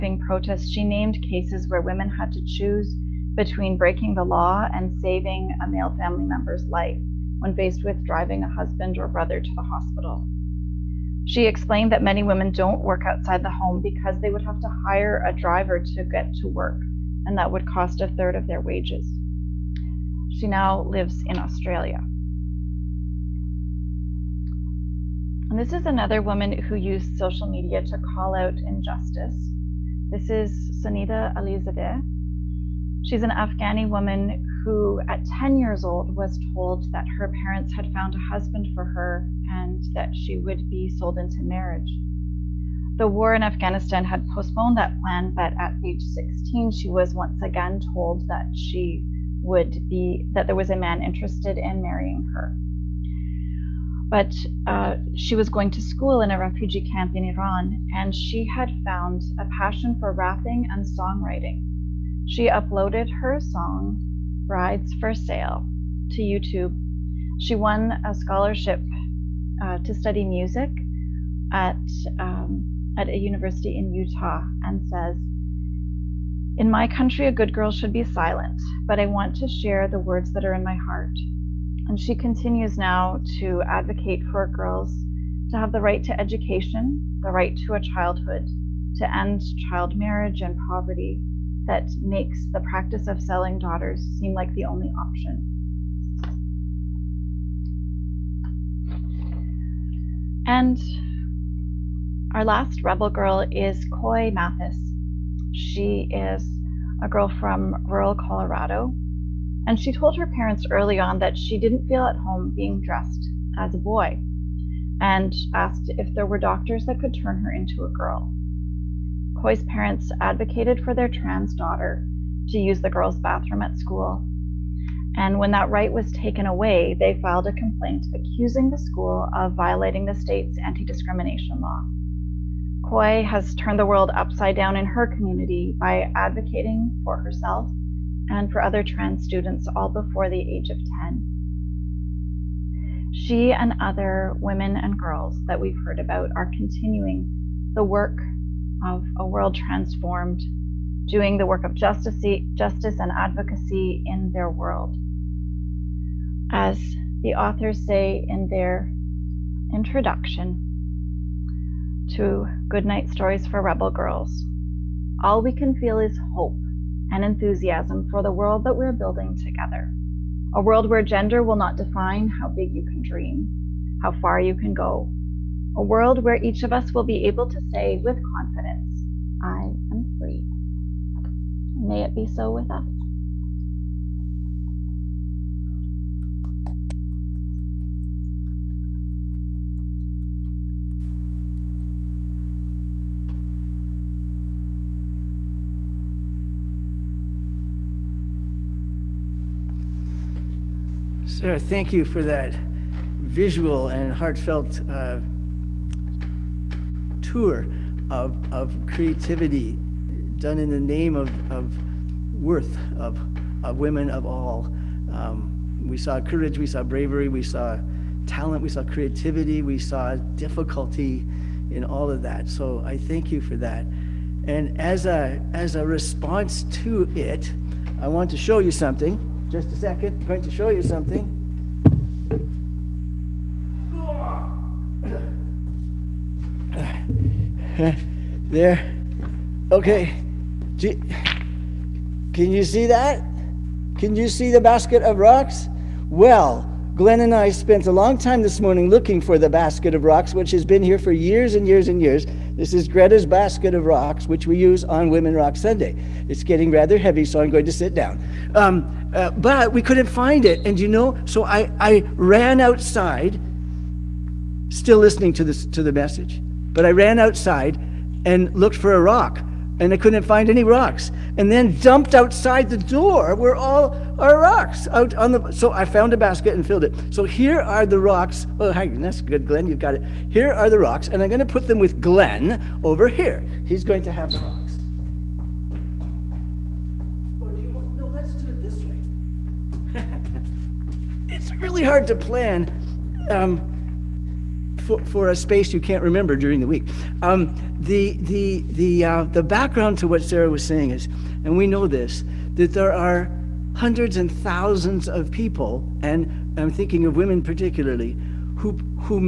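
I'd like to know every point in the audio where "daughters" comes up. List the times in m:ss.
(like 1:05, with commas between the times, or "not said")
1:33, 2:01.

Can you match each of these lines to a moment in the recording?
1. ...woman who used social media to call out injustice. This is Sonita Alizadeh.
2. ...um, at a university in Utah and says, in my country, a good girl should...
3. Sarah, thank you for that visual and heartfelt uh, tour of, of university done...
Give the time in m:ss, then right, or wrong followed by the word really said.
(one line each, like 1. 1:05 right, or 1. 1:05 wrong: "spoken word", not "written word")
1. 0:26 right
2. 1:12 right
3. 3:21 wrong: "creativity", not "university".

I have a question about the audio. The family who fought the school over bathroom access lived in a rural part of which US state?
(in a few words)
Colorado.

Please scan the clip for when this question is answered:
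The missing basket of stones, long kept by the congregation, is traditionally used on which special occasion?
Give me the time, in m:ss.
4:15.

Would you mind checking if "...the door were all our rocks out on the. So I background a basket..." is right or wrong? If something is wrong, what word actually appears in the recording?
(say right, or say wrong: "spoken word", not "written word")
wrong: "found", not "background".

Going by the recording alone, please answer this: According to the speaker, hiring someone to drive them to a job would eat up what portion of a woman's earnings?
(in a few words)
A third.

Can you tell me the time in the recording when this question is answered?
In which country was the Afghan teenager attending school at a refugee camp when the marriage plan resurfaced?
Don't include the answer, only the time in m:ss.
0:57.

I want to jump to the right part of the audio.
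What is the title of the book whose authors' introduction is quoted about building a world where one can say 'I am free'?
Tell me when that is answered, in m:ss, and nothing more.
2:42.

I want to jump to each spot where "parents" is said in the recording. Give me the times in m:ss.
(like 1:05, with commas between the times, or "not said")
0:37, 1:50, 1:59.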